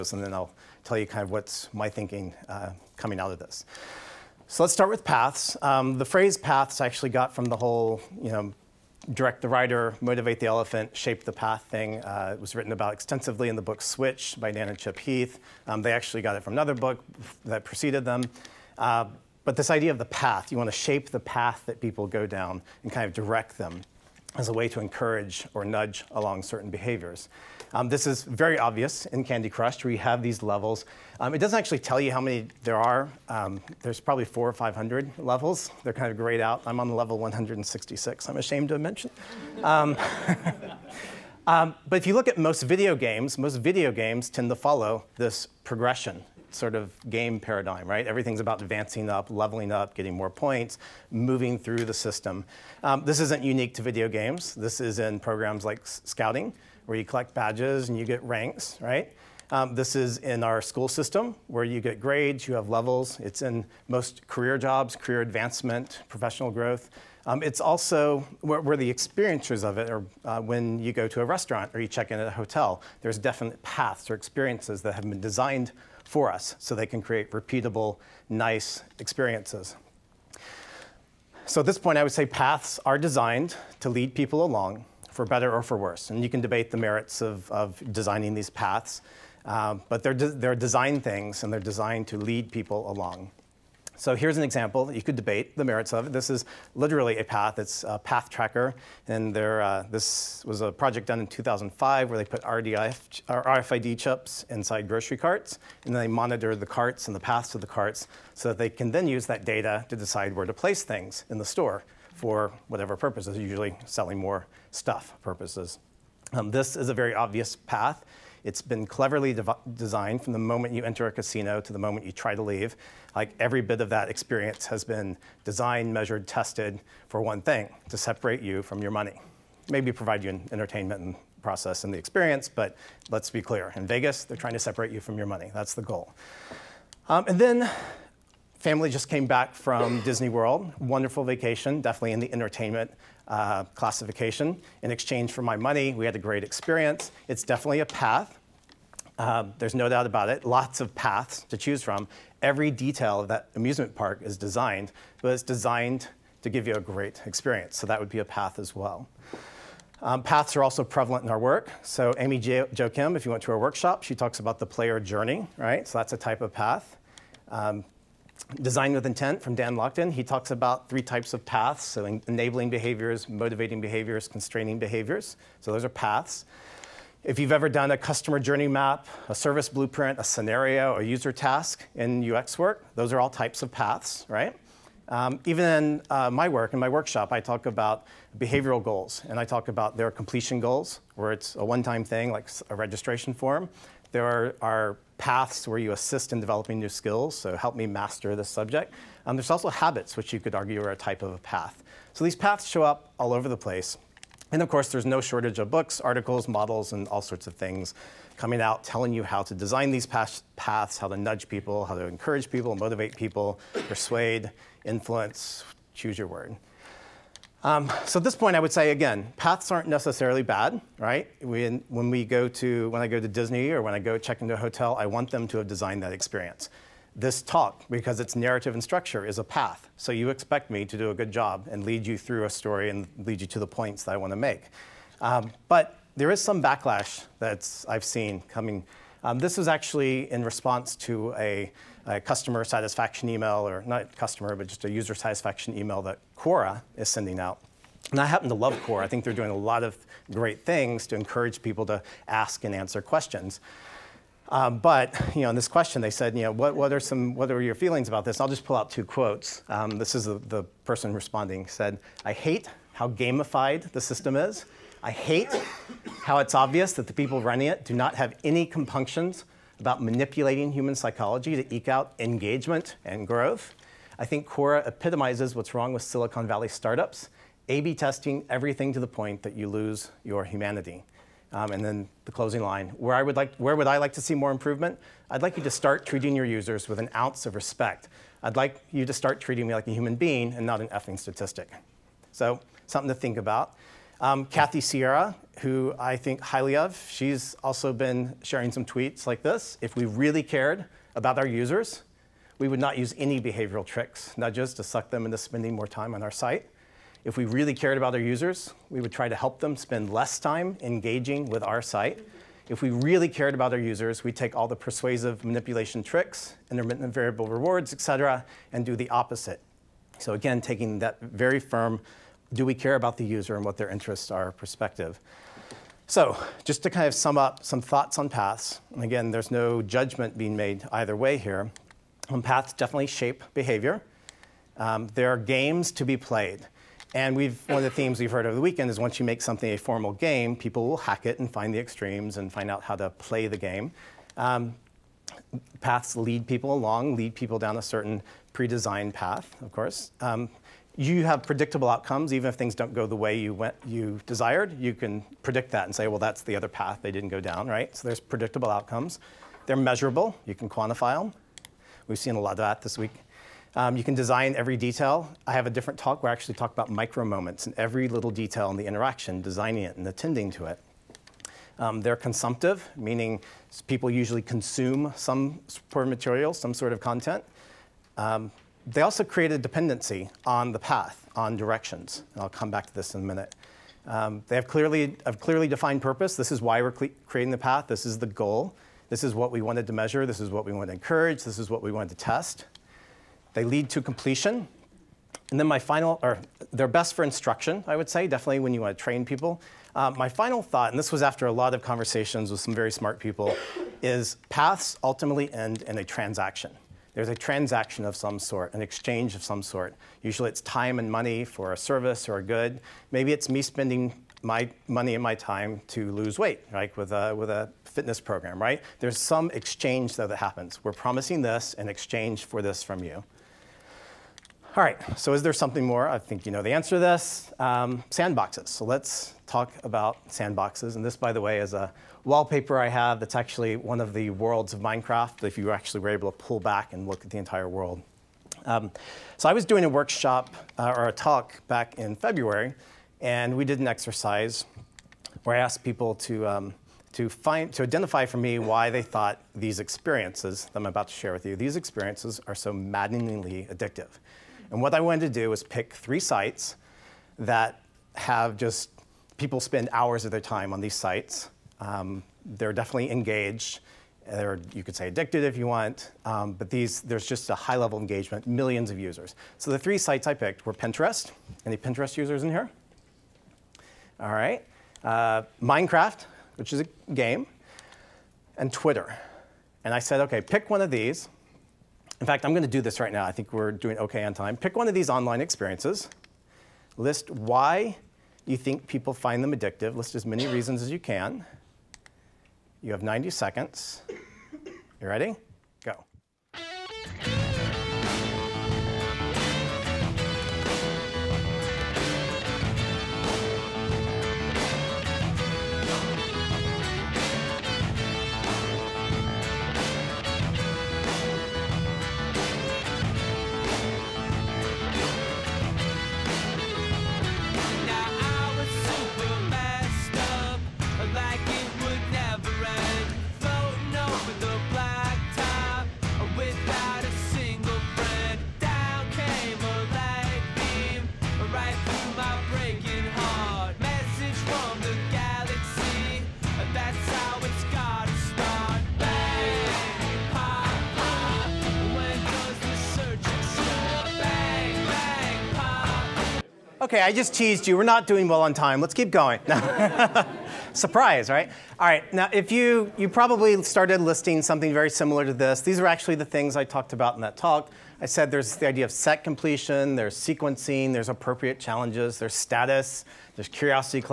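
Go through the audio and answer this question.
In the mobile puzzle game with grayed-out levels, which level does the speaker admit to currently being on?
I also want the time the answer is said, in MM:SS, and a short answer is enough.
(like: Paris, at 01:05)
166, at 00:37.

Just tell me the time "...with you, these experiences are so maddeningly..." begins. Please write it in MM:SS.
07:31.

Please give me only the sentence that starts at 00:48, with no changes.
Everything's about advancing up, leveling up, getting more points, moving through the system.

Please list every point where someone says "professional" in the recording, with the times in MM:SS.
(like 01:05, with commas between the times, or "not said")
01:06.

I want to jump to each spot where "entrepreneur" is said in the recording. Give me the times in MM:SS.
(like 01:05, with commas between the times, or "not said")
not said.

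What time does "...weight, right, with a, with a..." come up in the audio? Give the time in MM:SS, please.
06:56.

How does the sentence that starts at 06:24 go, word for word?
Um, they have clearly, have clearly defined purpose.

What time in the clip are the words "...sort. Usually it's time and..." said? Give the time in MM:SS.
06:49.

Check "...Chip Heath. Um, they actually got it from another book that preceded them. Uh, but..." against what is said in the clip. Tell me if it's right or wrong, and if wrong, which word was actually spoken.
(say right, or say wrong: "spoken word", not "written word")
right.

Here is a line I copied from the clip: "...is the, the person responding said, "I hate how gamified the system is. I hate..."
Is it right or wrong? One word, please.
right.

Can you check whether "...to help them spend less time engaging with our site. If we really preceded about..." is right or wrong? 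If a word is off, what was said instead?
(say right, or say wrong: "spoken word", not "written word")
wrong: "cared", not "preceded".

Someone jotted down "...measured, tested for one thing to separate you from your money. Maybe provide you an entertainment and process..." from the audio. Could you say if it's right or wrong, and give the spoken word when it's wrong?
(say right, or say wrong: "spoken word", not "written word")
right.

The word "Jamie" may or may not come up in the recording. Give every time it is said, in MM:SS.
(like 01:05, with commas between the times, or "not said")
not said.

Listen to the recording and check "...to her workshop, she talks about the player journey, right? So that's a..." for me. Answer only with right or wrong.
right.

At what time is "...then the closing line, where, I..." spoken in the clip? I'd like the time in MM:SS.
04:41.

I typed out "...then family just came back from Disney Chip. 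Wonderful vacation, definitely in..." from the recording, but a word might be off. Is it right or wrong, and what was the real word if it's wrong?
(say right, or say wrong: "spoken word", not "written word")
wrong: "World", not "Chip".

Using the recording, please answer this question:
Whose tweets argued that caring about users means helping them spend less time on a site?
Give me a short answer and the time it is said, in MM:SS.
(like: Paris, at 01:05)
Kathy Sierra, at 04:54.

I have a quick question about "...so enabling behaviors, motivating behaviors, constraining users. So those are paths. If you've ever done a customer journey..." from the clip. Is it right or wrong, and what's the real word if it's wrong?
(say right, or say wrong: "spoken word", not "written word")
wrong: "behaviors", not "users".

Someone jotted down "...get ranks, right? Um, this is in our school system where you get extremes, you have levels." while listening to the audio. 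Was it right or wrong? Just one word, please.
wrong.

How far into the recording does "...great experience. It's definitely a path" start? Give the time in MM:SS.
02:26.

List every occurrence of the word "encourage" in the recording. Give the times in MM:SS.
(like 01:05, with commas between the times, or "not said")
00:24, 03:32, 04:11, 06:30.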